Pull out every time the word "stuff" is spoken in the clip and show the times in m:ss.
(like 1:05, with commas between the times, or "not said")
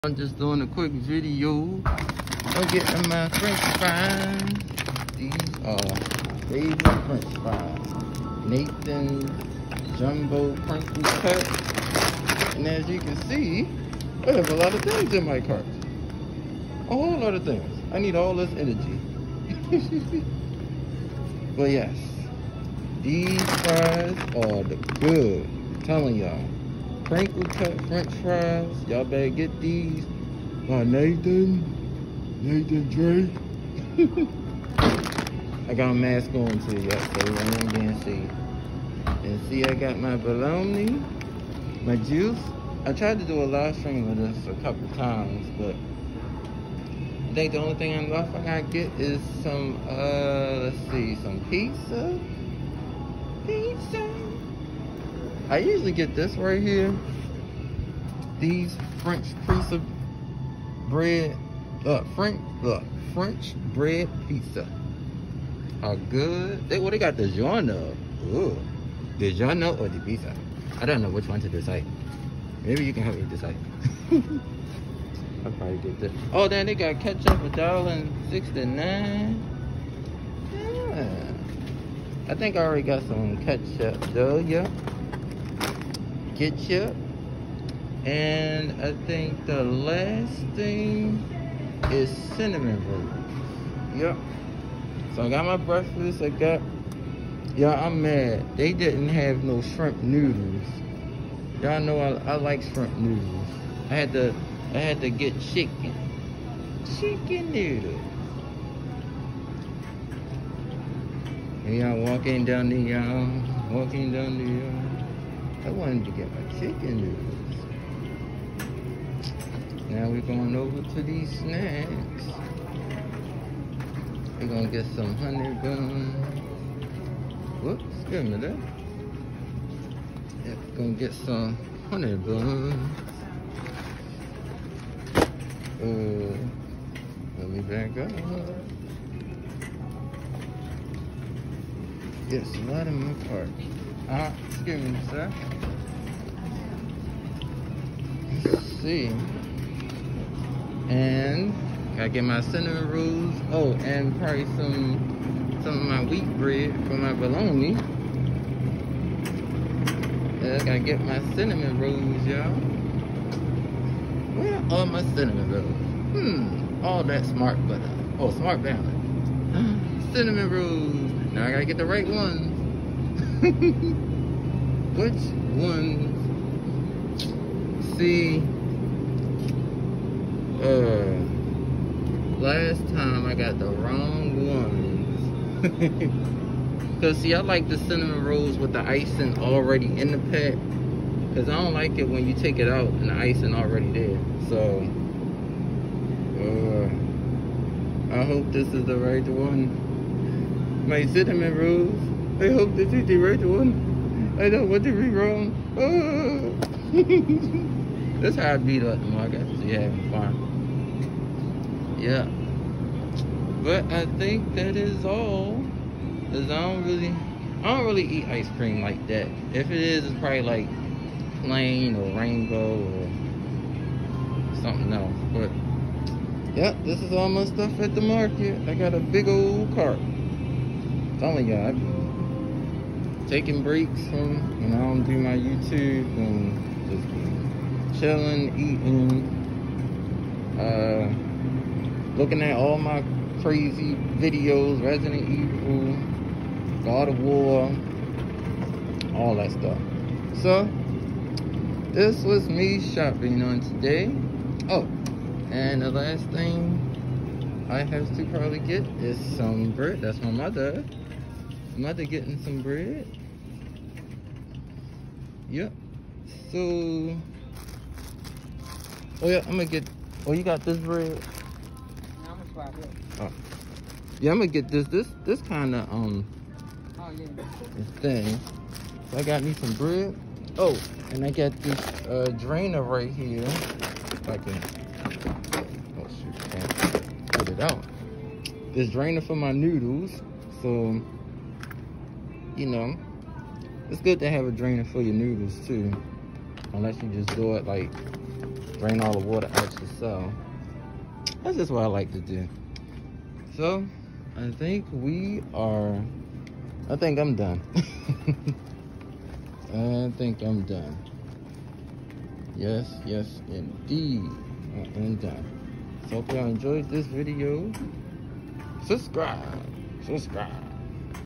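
3:47, 4:09.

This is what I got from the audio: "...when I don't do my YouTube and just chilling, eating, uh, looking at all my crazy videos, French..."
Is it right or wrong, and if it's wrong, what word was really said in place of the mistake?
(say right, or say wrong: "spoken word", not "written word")
wrong: "Resident", not "French".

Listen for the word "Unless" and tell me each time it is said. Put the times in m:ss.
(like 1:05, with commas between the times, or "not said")
4:56.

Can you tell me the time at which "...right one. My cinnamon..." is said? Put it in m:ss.
3:18.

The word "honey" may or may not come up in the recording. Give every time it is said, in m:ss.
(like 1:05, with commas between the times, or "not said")
2:05, 2:11.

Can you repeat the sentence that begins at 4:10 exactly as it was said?
So, this was me shopping on today.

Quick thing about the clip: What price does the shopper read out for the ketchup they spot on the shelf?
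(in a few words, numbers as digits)
$1.69.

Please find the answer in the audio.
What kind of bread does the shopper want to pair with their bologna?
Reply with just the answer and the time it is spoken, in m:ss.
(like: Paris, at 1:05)
Wheat bread, at 2:36.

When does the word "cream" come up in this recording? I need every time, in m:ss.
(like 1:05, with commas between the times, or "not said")
3:38.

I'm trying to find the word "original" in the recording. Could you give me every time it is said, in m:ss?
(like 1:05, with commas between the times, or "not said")
not said.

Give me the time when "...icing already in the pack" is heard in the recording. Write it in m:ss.
3:08.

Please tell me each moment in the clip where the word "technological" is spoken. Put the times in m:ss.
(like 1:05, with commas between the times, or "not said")
not said.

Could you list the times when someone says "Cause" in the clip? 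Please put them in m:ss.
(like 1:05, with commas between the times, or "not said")
3:07, 3:11, 3:36.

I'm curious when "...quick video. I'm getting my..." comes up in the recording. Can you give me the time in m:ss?
0:00.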